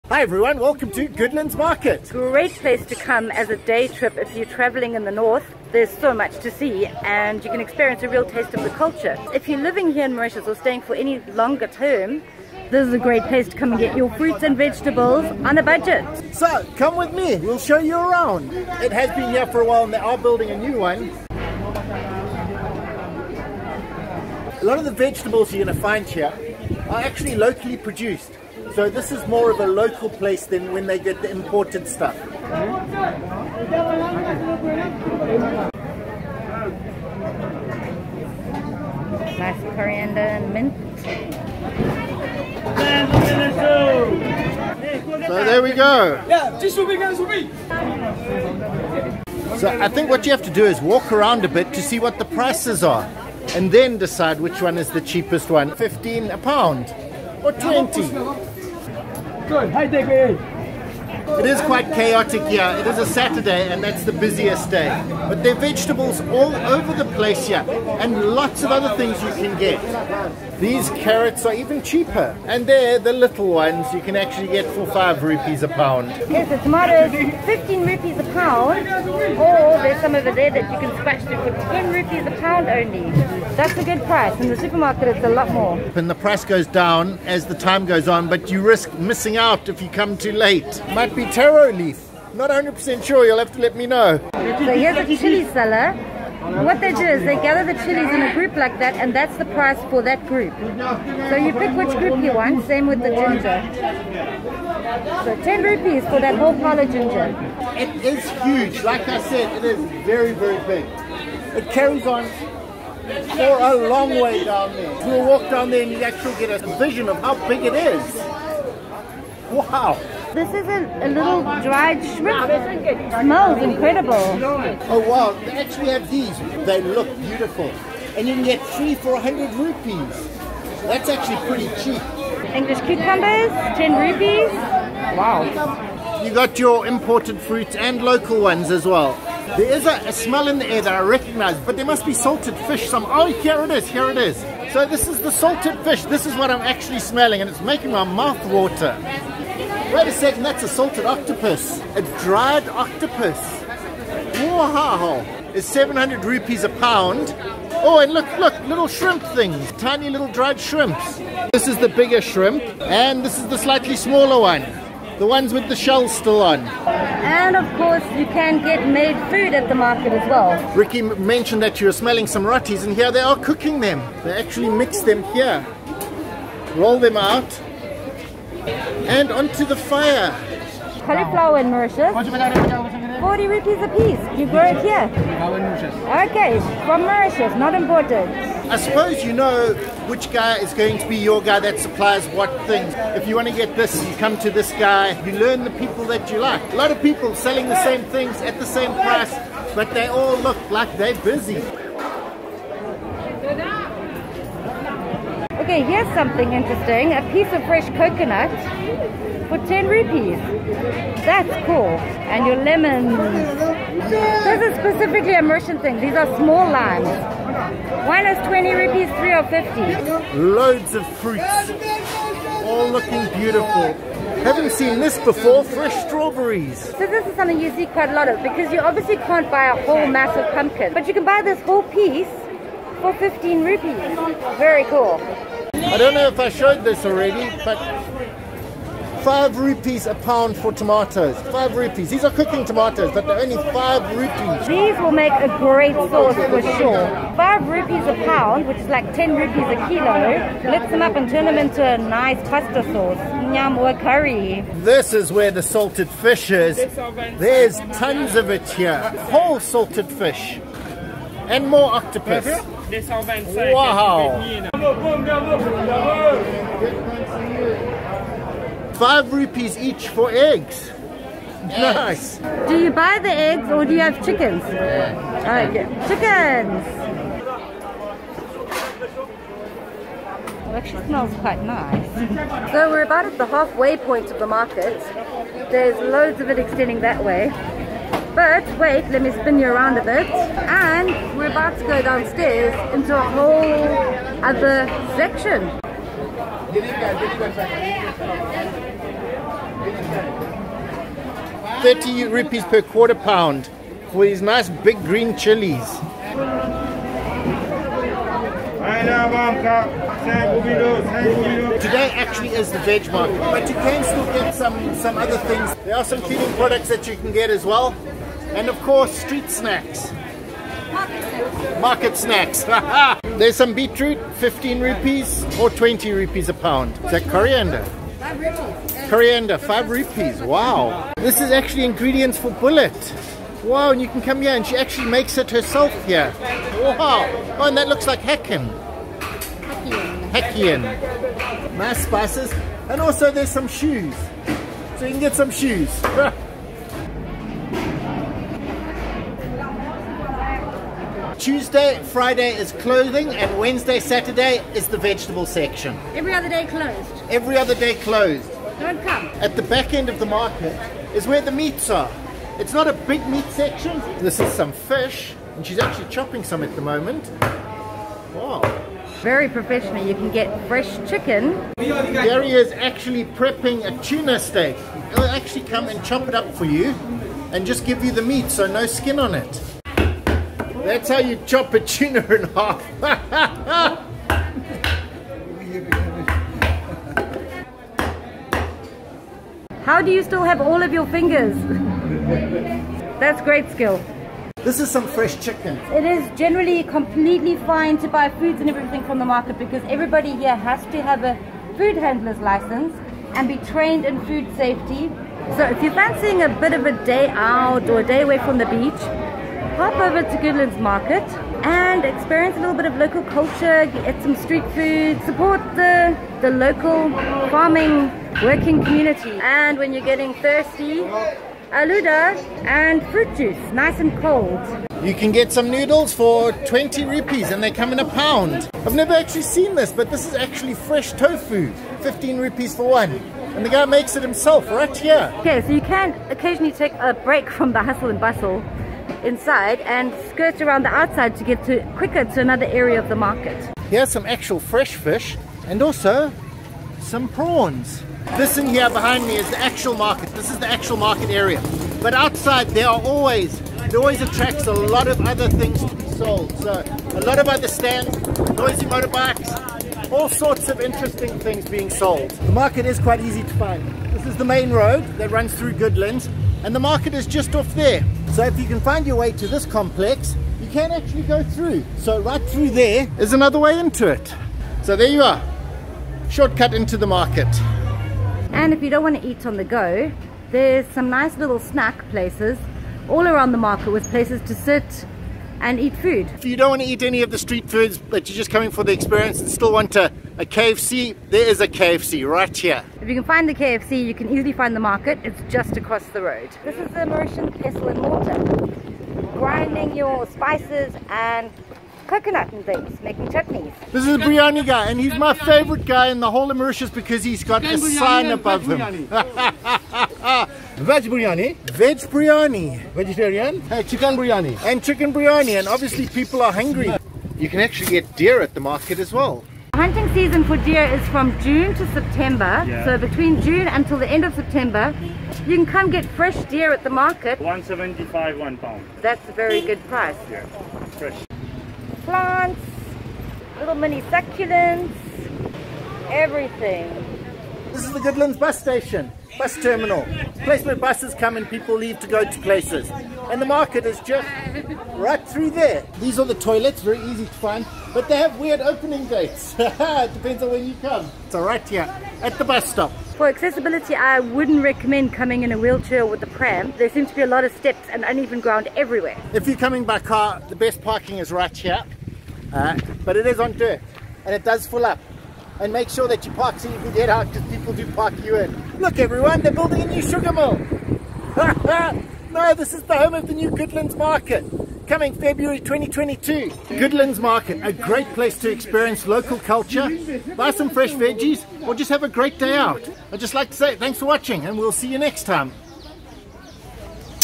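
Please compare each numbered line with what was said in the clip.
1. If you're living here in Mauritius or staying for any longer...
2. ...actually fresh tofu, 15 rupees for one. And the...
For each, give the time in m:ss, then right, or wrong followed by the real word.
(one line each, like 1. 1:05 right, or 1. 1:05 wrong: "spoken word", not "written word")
1. 0:09 right
2. 7:10 right.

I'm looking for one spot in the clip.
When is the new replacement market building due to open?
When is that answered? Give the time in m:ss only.
9:35.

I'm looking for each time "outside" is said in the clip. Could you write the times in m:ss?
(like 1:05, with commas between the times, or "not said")
7:20, 7:32.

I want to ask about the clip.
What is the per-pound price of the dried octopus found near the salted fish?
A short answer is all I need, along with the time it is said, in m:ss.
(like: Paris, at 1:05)
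700 rupees, at 2:35.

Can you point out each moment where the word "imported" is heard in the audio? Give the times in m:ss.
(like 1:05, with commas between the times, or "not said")
0:31, 2:16, 3:07.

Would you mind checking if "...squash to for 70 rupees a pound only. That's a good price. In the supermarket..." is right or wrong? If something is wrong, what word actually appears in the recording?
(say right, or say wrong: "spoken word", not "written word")
wrong: "10", not "70".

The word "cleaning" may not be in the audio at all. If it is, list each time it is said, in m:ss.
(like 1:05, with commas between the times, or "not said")
5:16.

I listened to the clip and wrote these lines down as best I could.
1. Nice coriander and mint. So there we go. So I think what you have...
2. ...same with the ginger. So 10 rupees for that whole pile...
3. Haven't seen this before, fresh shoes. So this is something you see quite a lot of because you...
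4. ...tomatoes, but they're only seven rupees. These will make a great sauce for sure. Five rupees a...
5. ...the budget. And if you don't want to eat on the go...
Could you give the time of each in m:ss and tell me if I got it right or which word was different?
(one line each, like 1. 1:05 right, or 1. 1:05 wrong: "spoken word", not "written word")
1. 0:39 right
2. 1:42 right
3. 3:44 wrong: "strawberries", not "shoes"
4. 4:02 wrong: "five", not "seven"
5. 7:56 wrong: "market", not "budget".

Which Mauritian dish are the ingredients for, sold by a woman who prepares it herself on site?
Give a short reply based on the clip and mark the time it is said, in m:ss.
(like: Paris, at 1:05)
Boulette, at 5:32.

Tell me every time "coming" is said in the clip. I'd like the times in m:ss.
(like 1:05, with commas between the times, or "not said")
8:08, 9:15, 9:19, 9:34.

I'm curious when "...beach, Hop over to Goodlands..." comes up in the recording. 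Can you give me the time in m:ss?
6:48.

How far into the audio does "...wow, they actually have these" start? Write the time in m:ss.
2:05.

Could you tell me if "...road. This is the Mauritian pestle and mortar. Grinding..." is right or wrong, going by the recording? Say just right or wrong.
right.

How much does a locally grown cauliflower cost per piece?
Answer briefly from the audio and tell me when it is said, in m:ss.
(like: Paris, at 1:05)
40 rupees, at 3:03.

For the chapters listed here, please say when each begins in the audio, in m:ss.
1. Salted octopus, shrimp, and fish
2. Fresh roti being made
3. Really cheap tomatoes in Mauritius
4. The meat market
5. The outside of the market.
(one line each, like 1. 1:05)
1. 2:21
2. 2:50
3. 3:55
4. 6:00
5. 7:15.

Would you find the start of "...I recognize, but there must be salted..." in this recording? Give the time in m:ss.
2:20.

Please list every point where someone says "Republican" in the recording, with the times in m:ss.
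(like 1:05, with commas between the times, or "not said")
not said.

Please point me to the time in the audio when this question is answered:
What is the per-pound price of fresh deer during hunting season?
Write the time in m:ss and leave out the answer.
8:47.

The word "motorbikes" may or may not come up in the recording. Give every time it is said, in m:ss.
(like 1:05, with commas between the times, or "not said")
7:38.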